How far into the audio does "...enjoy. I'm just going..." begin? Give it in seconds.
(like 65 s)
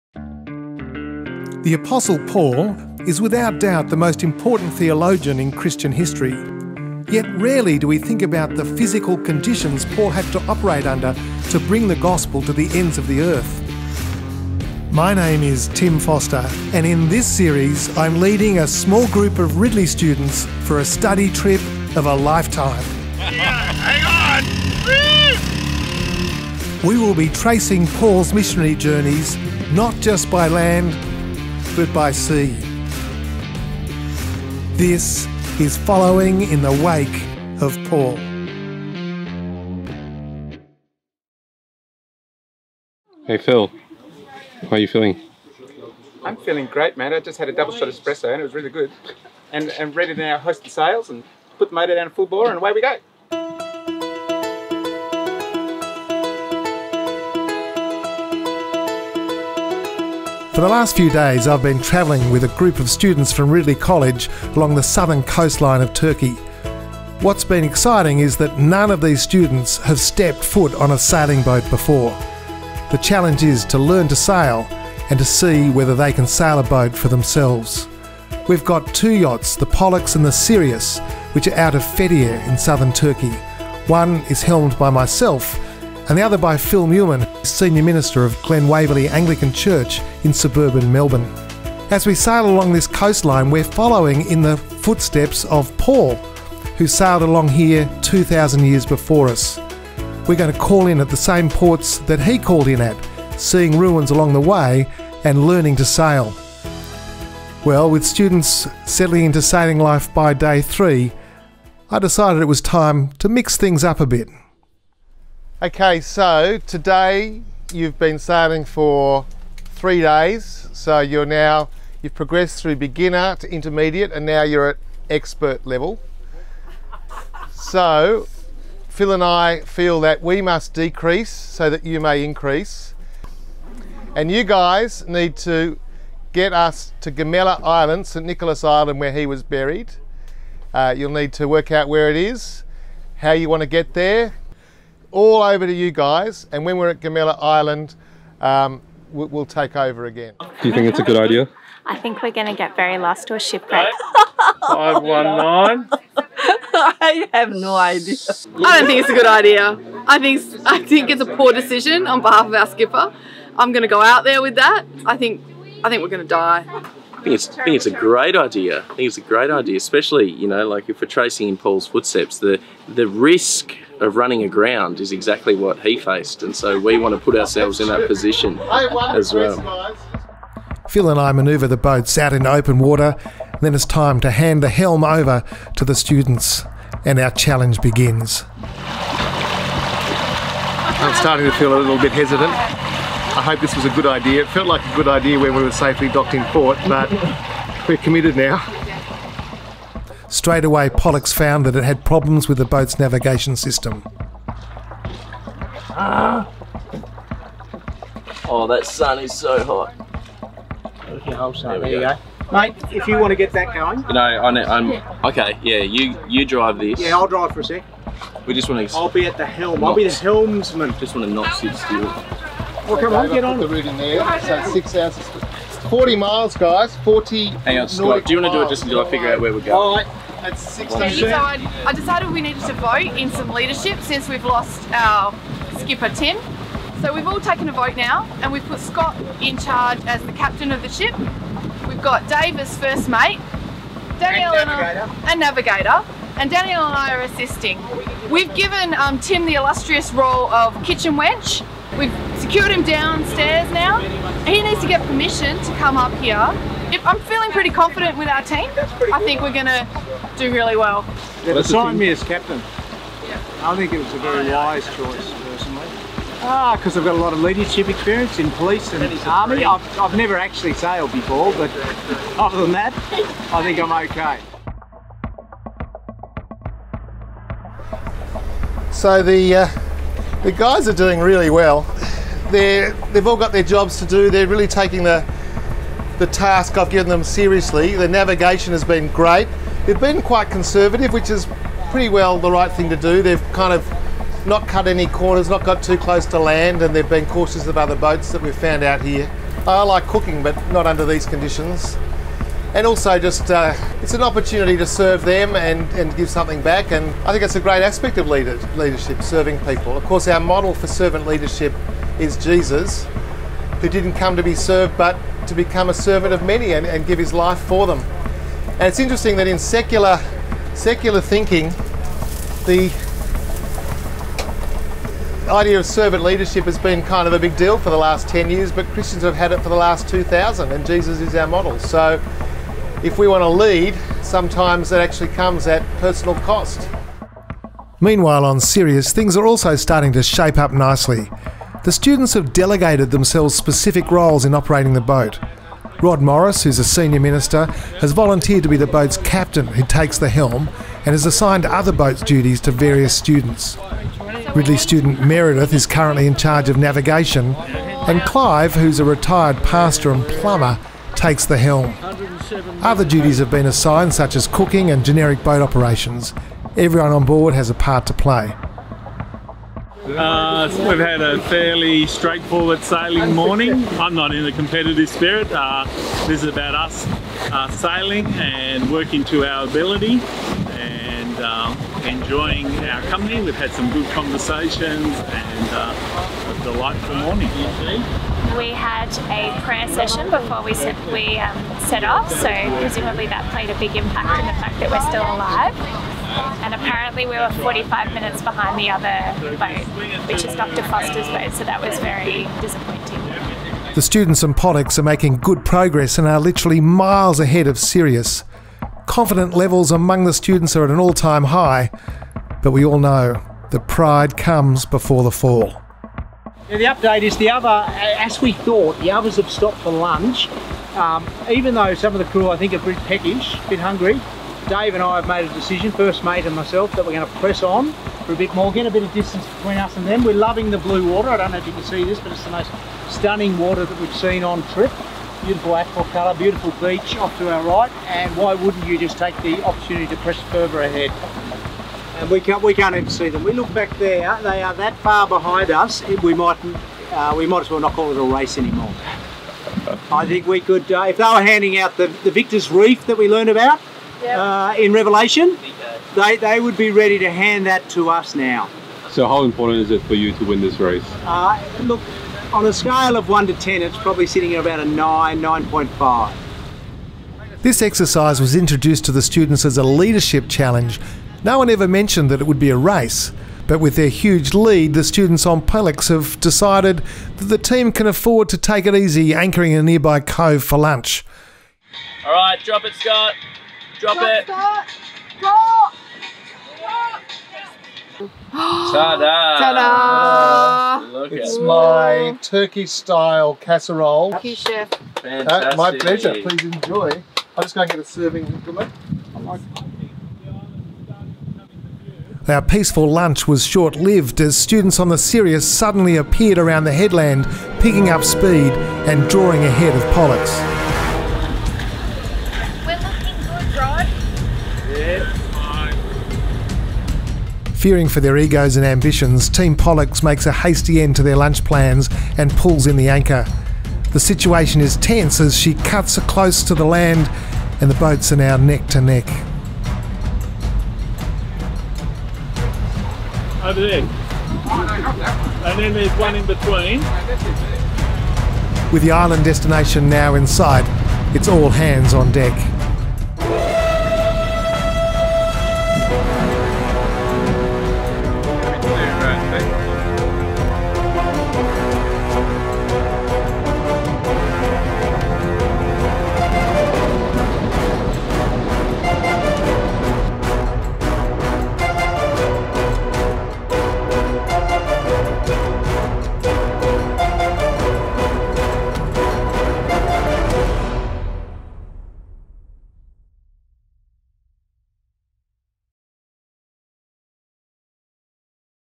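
496 s.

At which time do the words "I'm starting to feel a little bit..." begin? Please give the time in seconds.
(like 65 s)
188 s.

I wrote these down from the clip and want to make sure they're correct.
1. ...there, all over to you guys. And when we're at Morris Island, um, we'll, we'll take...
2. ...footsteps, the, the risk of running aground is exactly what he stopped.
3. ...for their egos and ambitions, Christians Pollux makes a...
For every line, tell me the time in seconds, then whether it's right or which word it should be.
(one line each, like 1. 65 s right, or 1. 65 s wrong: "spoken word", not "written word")
1. 143 s wrong: "Gemiler", not "Morris"
2. 171 s wrong: "faced", not "stopped"
3. 518 s wrong: "Team", not "Christians".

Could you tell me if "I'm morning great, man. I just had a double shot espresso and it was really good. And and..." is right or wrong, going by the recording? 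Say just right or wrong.
wrong.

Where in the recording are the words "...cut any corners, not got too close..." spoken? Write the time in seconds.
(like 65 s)
294 s.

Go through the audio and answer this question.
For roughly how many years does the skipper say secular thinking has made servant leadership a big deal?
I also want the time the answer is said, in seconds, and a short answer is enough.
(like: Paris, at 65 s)
10, at 328 s.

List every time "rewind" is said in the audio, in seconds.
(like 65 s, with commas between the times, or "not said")
not said.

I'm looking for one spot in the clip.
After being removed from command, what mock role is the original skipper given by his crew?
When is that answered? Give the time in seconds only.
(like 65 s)
250 s.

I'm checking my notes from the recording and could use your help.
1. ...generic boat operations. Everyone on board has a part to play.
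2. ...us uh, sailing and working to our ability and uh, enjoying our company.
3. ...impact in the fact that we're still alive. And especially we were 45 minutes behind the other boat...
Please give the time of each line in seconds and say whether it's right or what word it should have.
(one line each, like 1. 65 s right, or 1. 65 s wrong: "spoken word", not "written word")
1. 365 s right
2. 376 s right
3. 393 s wrong: "apparently", not "especially".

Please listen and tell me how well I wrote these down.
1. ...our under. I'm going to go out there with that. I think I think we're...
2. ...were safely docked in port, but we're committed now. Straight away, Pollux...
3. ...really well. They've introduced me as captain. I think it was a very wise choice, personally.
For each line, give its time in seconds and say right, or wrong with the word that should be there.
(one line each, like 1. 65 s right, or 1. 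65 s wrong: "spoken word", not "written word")
1. 162 s wrong: "skipper", not "under"
2. 195 s right
3. 260 s wrong: "assigned", not "introduced".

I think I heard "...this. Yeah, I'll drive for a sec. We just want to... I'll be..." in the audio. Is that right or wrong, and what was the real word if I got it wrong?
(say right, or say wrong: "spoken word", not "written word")
right.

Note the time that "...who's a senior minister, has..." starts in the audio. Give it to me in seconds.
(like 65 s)
346 s.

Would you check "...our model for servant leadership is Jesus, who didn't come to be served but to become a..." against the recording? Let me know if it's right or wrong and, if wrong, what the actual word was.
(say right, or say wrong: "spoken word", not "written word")
right.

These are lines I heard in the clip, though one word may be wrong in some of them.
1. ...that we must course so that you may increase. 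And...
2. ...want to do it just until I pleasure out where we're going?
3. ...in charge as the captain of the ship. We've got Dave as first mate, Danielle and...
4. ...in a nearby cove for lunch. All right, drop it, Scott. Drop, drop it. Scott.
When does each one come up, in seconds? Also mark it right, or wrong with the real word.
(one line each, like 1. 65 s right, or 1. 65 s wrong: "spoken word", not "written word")
1. 130 s wrong: "decrease", not "course"
2. 228 s wrong: "figure", not "pleasure"
3. 239 s right
4. 479 s right.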